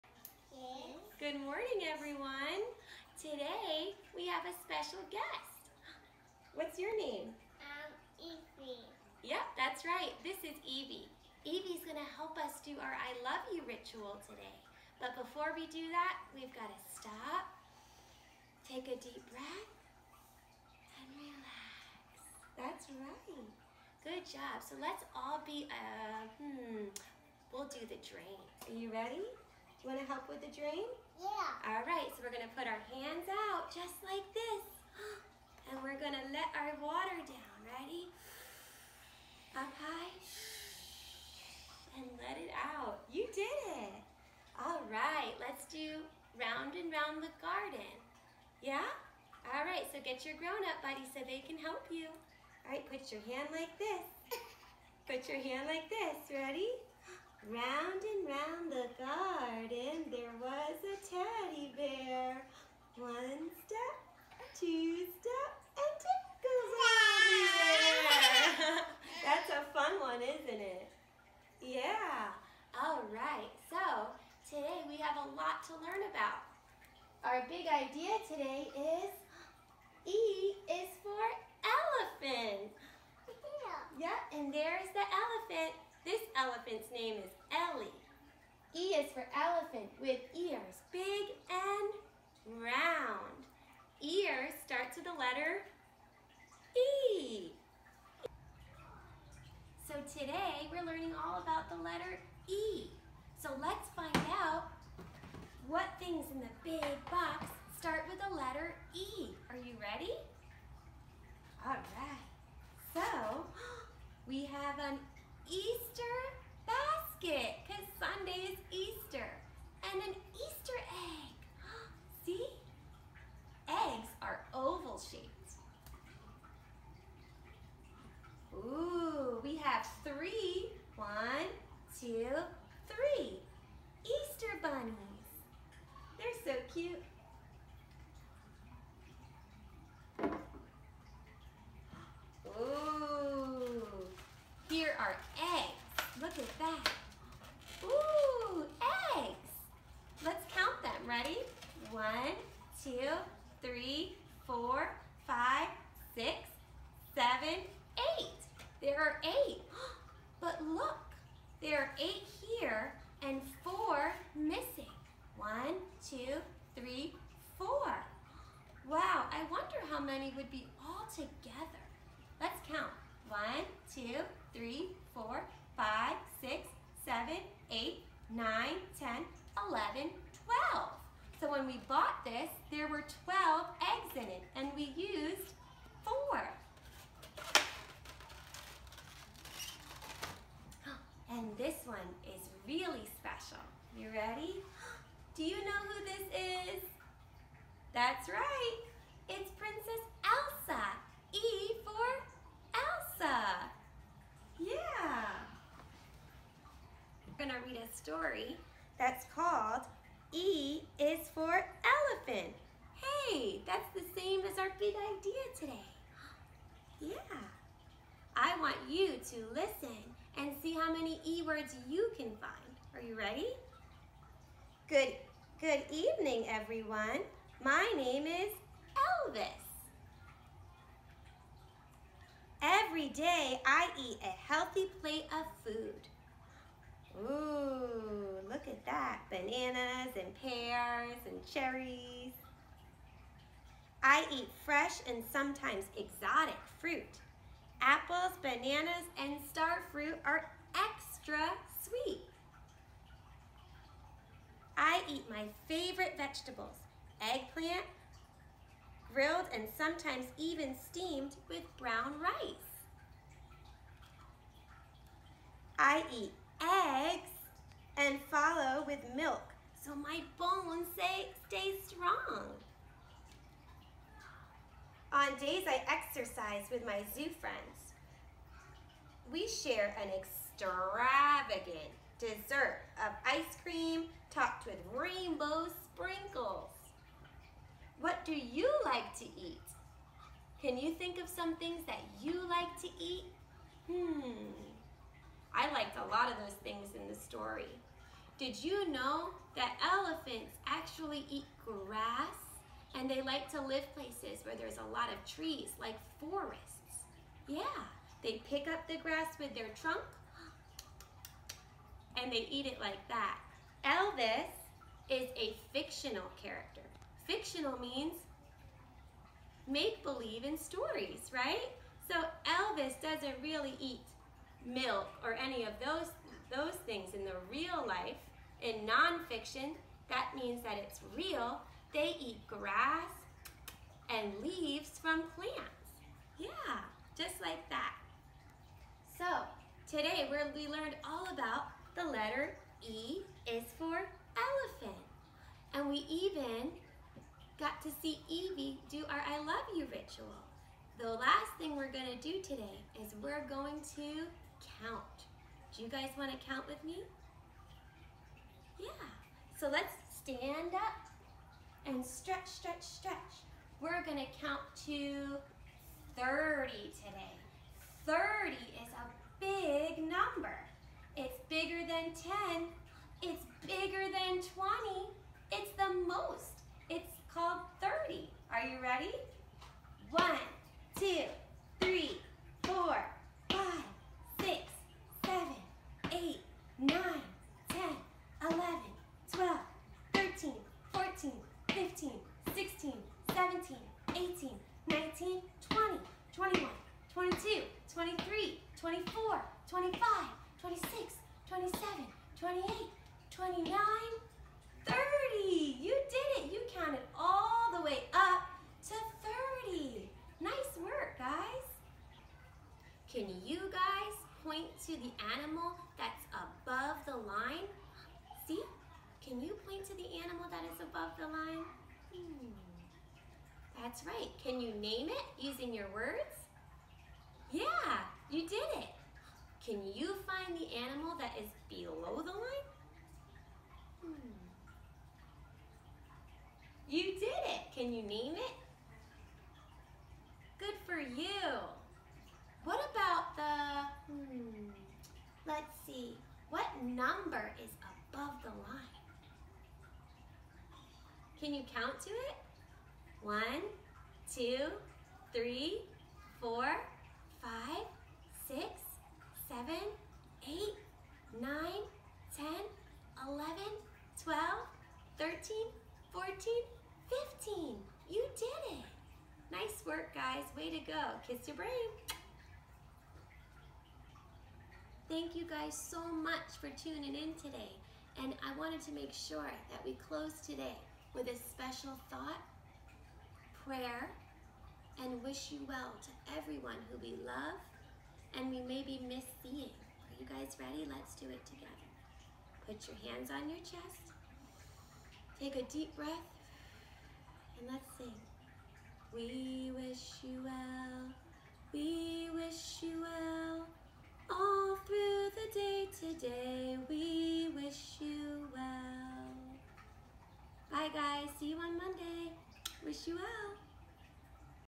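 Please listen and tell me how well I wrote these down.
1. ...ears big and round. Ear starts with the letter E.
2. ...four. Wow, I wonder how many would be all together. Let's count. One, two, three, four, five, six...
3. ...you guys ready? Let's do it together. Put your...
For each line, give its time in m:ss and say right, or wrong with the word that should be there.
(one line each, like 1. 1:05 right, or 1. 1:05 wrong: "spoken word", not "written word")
1. 1:30 right
2. 2:47 right
3. 8:10 right.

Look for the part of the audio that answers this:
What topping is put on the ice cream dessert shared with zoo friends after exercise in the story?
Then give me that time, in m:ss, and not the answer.
4:44.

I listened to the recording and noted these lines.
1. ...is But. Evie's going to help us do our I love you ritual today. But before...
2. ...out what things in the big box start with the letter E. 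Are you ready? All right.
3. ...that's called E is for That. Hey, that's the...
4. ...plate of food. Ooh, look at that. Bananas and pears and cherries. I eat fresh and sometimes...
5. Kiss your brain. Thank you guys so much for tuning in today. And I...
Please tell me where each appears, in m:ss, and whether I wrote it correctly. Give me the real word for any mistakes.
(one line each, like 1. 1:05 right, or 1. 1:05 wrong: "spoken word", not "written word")
1. 0:10 wrong: "Evie", not "But"
2. 1:44 right
3. 3:28 wrong: "Elephant", not "That"
4. 3:55 right
5. 7:51 right.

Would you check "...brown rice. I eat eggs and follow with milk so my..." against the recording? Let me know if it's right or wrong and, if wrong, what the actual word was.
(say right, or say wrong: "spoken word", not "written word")
right.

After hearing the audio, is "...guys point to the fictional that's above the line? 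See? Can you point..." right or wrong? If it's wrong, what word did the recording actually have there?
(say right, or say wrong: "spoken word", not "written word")
wrong: "animal", not "fictional".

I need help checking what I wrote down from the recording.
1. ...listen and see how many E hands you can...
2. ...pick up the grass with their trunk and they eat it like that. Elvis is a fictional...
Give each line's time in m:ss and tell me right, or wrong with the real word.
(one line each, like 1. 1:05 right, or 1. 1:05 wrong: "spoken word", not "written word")
1. 3:39 wrong: "words", not "hands"
2. 5:08 right.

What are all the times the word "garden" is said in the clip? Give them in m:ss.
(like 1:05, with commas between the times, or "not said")
0:47, 0:59.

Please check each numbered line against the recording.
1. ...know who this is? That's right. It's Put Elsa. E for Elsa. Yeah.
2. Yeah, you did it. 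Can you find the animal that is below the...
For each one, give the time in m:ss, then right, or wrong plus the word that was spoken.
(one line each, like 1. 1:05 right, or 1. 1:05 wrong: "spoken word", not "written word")
1. 3:15 wrong: "Princess", not "Put"
2. 7:07 right.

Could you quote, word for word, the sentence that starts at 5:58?
Yeah, so let's stand up and stretch, stretch, stretch.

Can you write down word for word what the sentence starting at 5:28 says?
In nonfiction, that means that it's real they eat grass and leaves from plants.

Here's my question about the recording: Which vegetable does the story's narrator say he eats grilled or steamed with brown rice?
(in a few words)
Eggplant.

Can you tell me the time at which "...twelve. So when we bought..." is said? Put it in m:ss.
3:00.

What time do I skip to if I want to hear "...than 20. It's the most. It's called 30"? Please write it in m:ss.
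6:14.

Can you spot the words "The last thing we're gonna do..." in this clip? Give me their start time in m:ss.
5:50.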